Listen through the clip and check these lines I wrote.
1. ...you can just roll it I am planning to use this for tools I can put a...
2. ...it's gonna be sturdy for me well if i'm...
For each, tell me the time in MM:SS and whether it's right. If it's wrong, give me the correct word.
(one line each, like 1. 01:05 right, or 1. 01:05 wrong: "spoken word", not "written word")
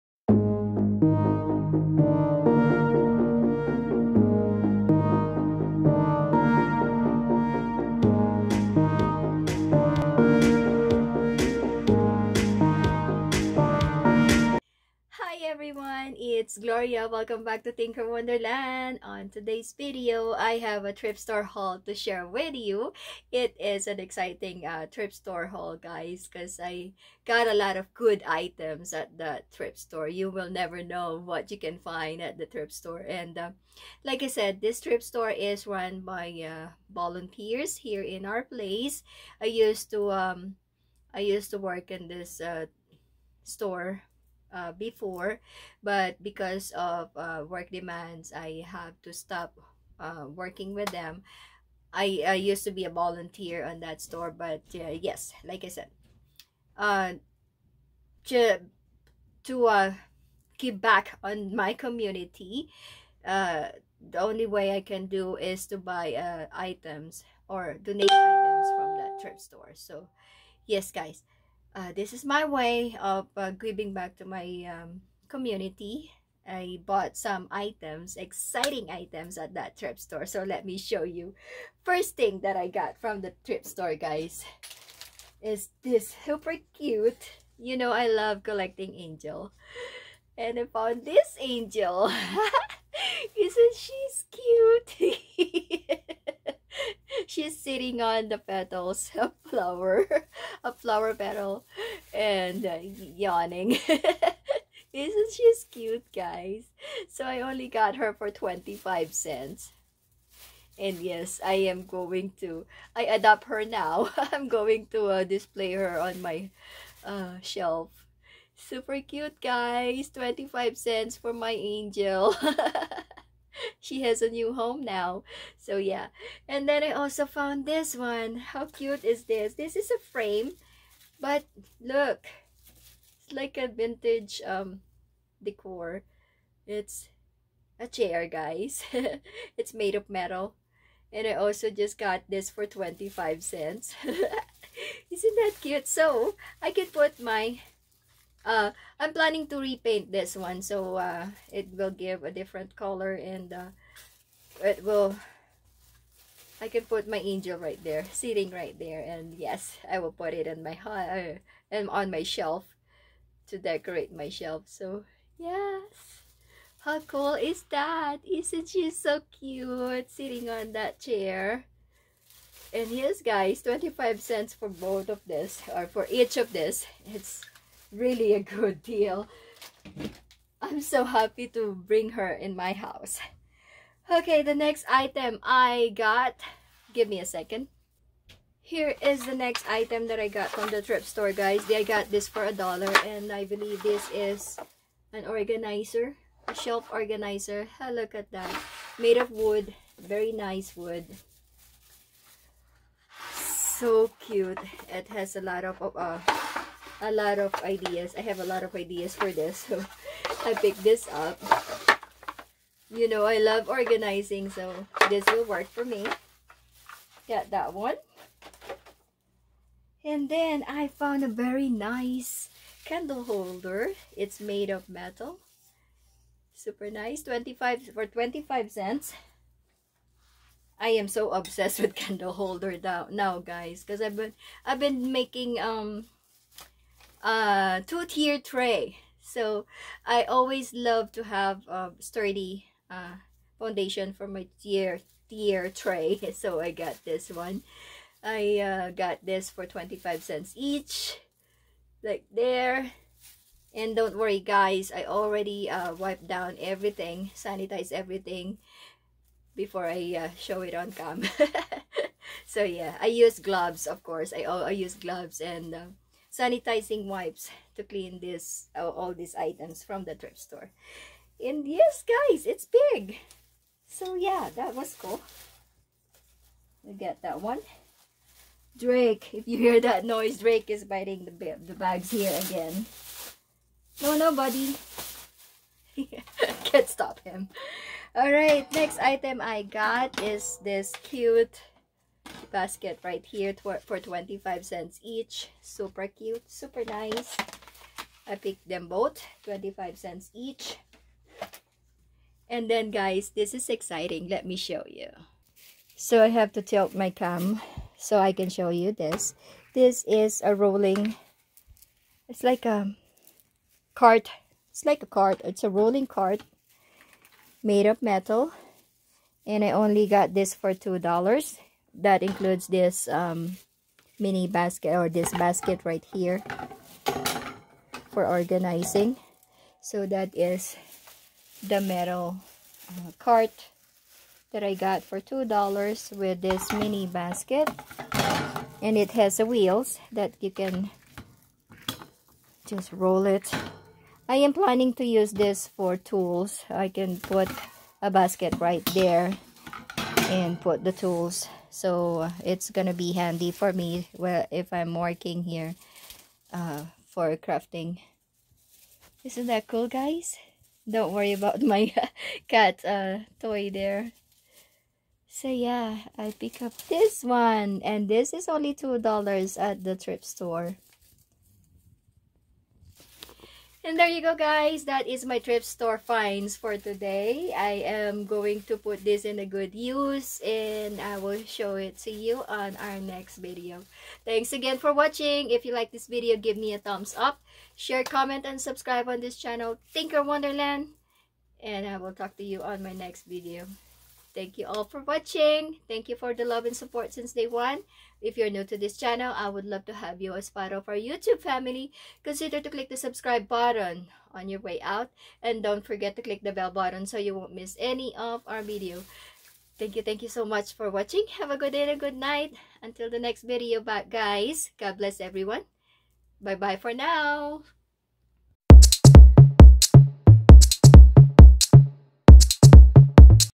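1. 05:40 right
2. 05:52 wrong: "handy", not "sturdy".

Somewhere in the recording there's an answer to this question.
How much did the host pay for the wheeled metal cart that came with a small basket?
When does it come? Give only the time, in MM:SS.
05:20.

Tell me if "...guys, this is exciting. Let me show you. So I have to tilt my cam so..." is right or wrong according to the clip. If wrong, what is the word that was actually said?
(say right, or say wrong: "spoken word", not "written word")
right.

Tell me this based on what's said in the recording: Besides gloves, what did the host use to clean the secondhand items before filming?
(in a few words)
Sanitizing wipes.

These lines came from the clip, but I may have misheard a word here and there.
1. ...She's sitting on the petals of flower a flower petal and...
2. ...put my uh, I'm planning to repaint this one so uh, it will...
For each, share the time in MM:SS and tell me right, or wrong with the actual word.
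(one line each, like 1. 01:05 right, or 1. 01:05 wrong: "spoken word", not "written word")
1. 01:37 right
2. 02:26 right.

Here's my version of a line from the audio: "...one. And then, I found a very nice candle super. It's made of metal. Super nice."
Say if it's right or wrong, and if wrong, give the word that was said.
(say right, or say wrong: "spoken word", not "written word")
wrong: "holder", not "super".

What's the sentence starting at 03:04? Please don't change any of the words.
Okay, the next item I got, give me a second.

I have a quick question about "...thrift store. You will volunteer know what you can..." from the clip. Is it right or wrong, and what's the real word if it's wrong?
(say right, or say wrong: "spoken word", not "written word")
wrong: "never", not "volunteer".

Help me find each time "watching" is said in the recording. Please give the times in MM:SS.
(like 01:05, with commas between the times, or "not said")
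06:24, 06:35, 06:50.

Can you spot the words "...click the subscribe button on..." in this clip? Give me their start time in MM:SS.
06:42.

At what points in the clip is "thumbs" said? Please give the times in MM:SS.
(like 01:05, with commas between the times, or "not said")
06:26.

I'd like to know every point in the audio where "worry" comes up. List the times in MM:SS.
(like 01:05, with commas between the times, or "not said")
04:14, 06:01.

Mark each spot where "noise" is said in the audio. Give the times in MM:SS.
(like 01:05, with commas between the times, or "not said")
04:40.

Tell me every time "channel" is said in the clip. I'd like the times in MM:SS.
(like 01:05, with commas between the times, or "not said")
06:29, 06:38.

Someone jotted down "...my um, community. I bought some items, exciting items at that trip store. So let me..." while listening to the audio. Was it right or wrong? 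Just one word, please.
right.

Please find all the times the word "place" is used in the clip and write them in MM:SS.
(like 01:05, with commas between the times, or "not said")
00:38.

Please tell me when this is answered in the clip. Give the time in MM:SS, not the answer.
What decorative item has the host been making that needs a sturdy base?
03:57.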